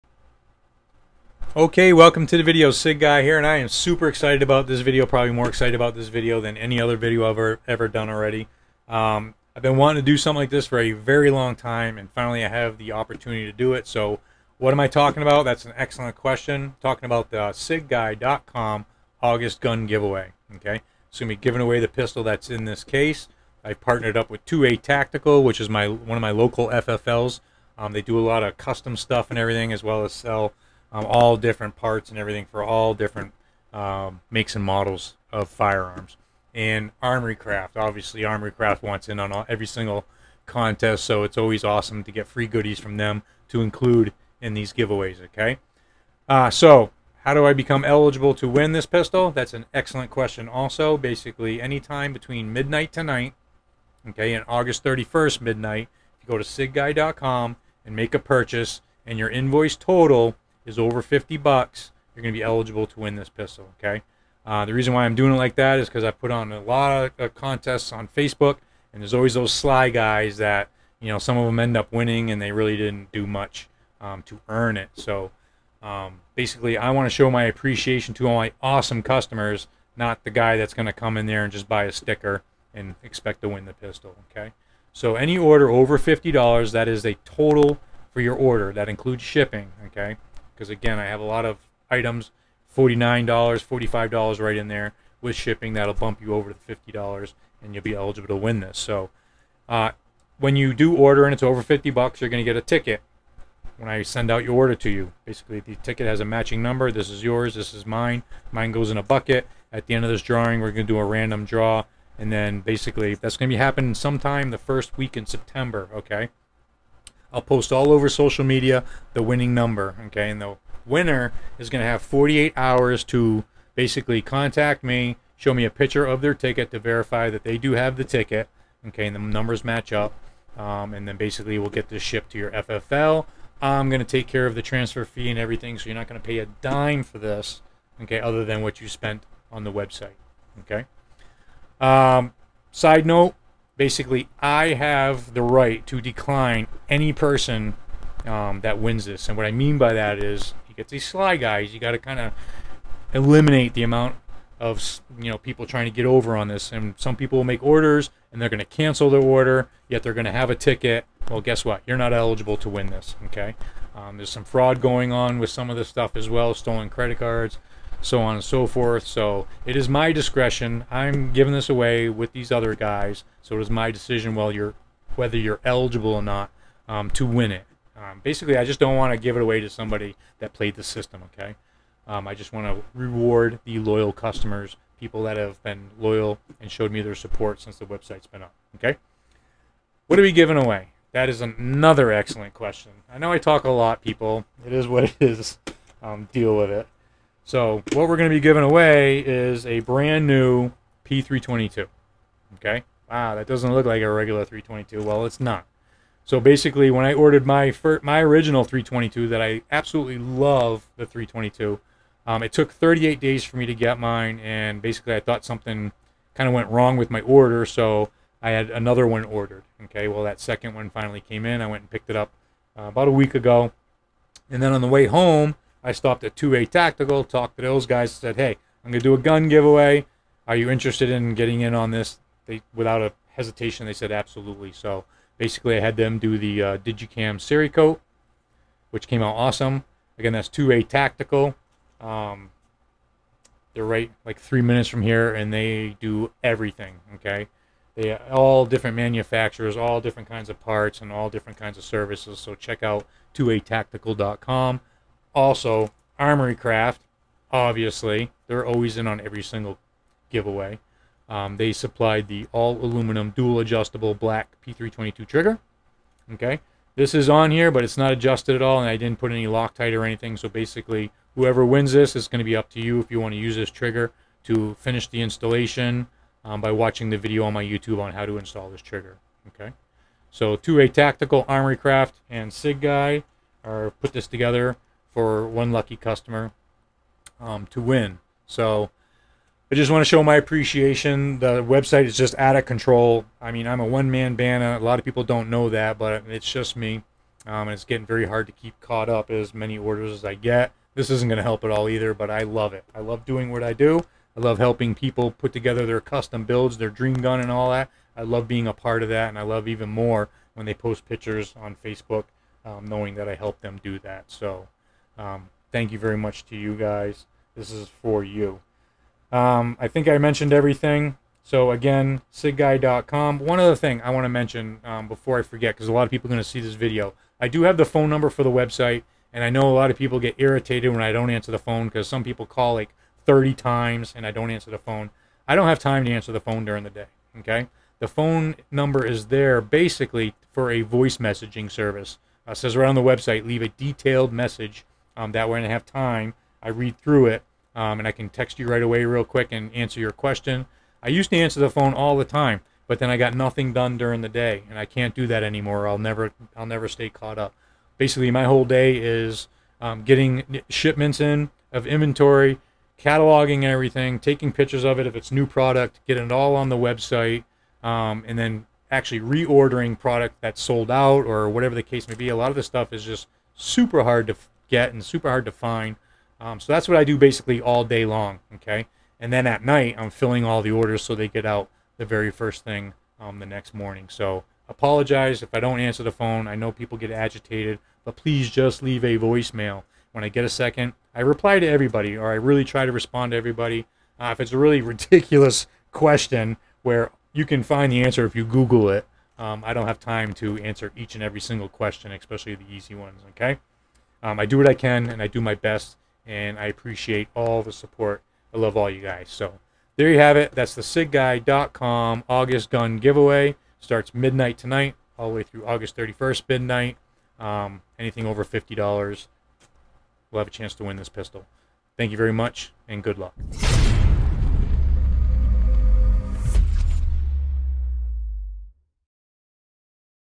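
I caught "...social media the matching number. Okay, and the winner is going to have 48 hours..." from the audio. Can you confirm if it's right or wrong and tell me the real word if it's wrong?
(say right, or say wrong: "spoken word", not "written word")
wrong: "winning", not "matching".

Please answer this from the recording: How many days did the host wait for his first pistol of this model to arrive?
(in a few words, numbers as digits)
38.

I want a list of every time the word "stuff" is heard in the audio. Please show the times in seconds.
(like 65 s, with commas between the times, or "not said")
28 s, 165 s, 372 s.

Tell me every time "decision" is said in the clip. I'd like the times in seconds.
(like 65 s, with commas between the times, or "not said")
173 s.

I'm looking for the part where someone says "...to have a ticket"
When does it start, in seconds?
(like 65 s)
160 s.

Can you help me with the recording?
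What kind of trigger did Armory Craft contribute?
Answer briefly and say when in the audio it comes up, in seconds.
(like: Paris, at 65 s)
aluminum dual adjustable, at 262 s.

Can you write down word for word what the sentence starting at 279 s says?
Okay, so 2A Tactical, Armory Craft, and Sig Guy are put this together for one lucky customer um, to win.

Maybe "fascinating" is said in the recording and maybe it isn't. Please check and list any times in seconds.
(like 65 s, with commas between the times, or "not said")
not said.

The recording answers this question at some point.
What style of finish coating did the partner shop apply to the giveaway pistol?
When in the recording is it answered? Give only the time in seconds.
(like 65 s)
236 s.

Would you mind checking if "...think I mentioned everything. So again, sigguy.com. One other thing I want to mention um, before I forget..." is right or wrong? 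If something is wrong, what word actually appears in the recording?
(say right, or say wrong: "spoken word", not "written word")
right.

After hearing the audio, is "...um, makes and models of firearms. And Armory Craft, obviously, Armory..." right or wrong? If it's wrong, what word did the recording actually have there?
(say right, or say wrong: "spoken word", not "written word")
right.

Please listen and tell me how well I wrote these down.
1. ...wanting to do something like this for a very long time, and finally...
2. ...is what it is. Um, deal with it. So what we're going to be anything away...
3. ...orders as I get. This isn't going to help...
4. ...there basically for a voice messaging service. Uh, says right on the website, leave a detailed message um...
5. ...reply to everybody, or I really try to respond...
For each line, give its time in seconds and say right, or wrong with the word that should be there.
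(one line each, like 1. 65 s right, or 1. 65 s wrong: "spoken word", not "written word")
1. 9 s right
2. 194 s wrong: "giving", not "anything"
3. 299 s right
4. 339 s right
5. 391 s right.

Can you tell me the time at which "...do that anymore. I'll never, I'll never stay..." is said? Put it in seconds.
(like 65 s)
355 s.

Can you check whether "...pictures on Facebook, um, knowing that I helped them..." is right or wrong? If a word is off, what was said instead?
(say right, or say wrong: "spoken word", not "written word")
right.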